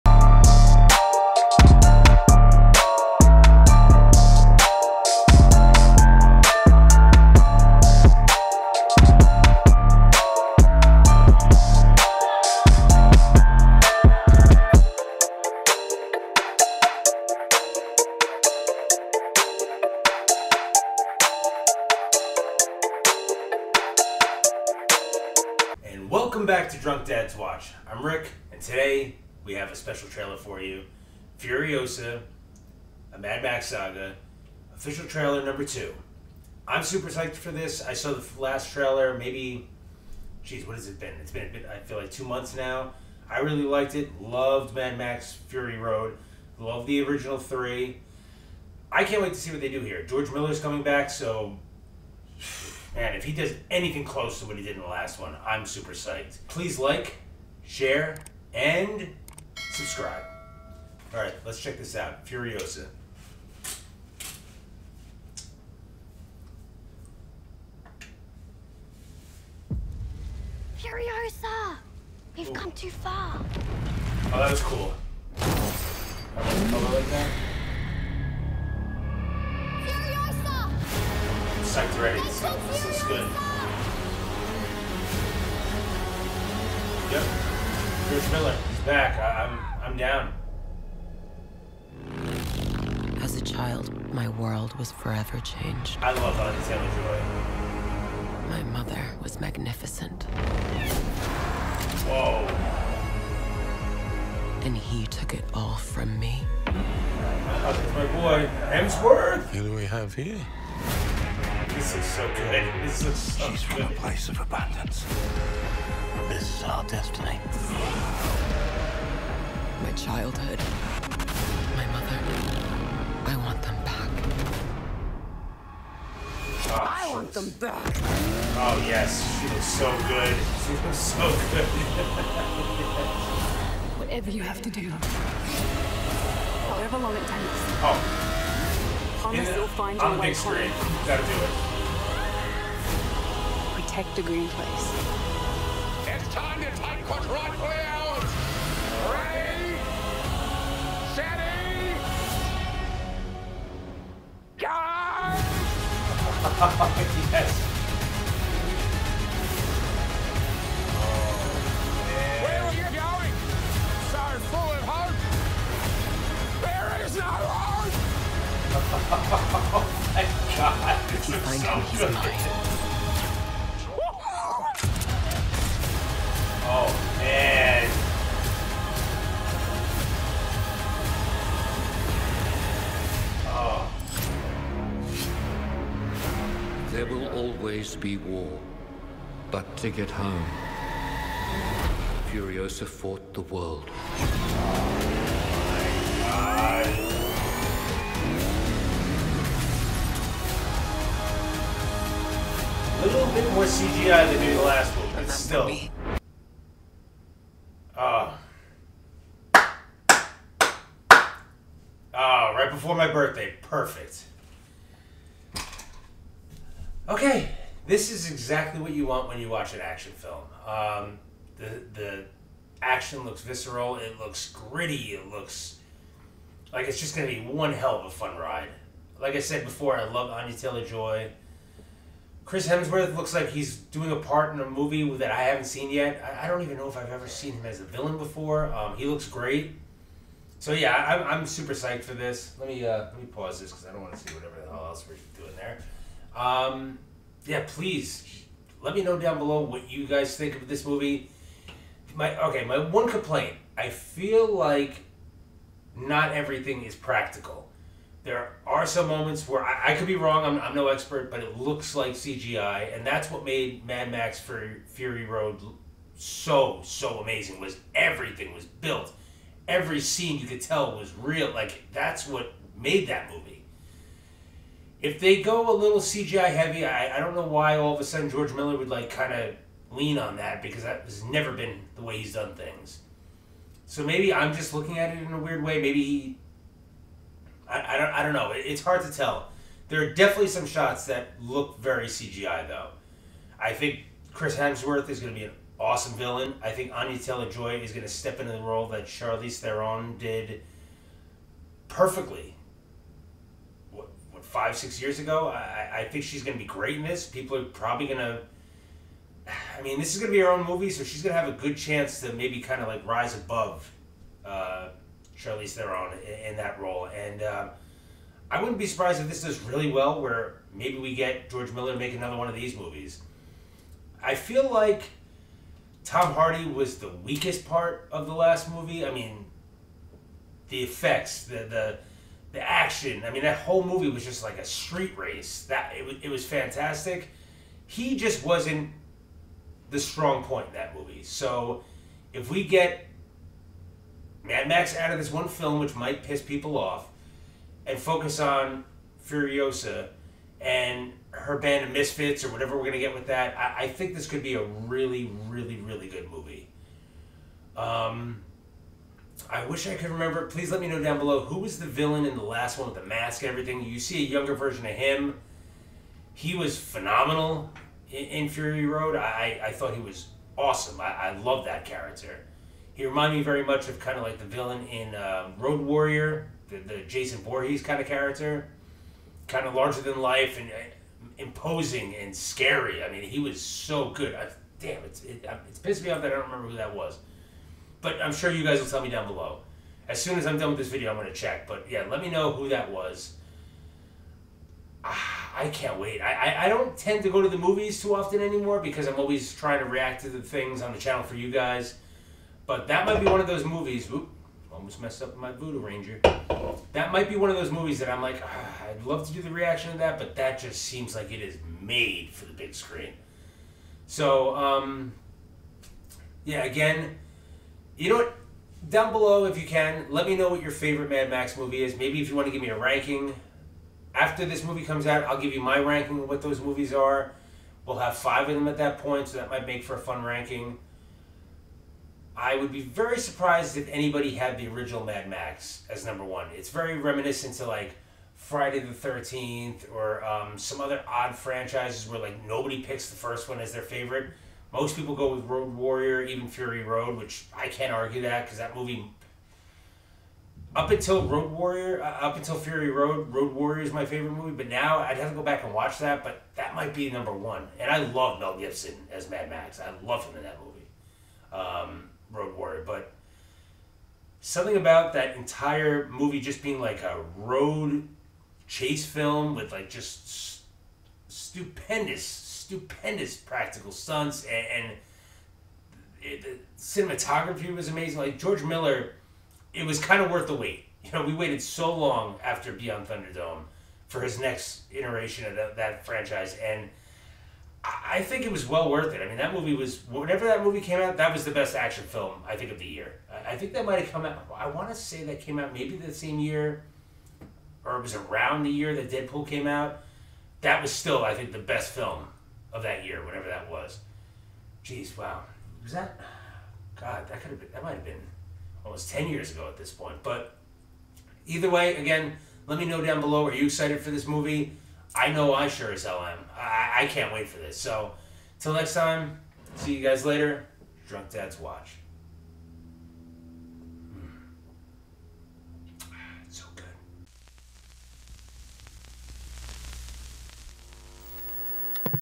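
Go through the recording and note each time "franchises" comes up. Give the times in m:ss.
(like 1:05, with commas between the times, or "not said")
7:21, 8:06.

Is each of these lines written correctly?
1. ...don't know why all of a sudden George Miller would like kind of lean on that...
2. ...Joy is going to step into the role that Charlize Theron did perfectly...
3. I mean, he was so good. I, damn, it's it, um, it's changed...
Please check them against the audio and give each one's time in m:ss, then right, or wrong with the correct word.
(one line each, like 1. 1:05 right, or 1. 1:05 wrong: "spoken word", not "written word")
1. 4:37 right
2. 4:57 right
3. 6:23 wrong: "pissed", not "changed".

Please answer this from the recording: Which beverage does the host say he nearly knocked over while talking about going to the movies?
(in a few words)
Voodoo Ranger.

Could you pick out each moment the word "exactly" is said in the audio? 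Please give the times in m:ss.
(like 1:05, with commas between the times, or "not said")
3:38.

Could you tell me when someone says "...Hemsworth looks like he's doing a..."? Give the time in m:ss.
3:52.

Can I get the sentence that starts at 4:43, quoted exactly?
So maybe I'm just looking at it in a weird way.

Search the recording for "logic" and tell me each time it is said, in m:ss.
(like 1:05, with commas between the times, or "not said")
not said.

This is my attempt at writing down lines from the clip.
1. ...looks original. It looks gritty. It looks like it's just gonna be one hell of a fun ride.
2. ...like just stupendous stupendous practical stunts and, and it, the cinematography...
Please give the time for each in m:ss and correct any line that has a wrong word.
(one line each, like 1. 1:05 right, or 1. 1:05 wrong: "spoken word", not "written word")
1. 3:43 wrong: "visceral", not "original"
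2. 7:49 right.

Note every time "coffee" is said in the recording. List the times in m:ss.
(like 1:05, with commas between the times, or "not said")
not said.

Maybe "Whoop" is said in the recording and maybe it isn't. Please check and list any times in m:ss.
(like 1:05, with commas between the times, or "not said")
6:44.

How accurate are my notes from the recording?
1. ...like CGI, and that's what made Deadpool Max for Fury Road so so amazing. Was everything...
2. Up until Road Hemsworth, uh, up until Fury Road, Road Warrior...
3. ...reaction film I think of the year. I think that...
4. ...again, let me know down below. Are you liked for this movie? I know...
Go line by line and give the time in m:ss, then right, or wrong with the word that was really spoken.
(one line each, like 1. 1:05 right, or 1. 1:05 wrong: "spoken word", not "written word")
1. 4:21 wrong: "Mad", not "Deadpool"
2. 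7:30 wrong: "Warrior", not "Hemsworth"
3. 8:11 wrong: "action", not "reaction"
4. 8:31 wrong: "excited", not "liked".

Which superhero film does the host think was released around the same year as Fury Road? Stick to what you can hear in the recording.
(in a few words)
Deadpool.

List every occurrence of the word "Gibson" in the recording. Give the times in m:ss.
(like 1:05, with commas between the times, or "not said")
7:38.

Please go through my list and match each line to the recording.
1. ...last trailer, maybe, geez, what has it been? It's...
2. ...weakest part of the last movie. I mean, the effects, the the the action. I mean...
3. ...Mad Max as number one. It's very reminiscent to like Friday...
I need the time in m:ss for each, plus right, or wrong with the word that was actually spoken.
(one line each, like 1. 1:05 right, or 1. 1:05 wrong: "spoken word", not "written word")
1. 0:38 right
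2. 5:27 right
3. 7:15 right.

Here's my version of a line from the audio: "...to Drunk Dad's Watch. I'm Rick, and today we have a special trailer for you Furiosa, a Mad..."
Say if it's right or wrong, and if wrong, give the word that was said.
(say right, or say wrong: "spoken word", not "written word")
right.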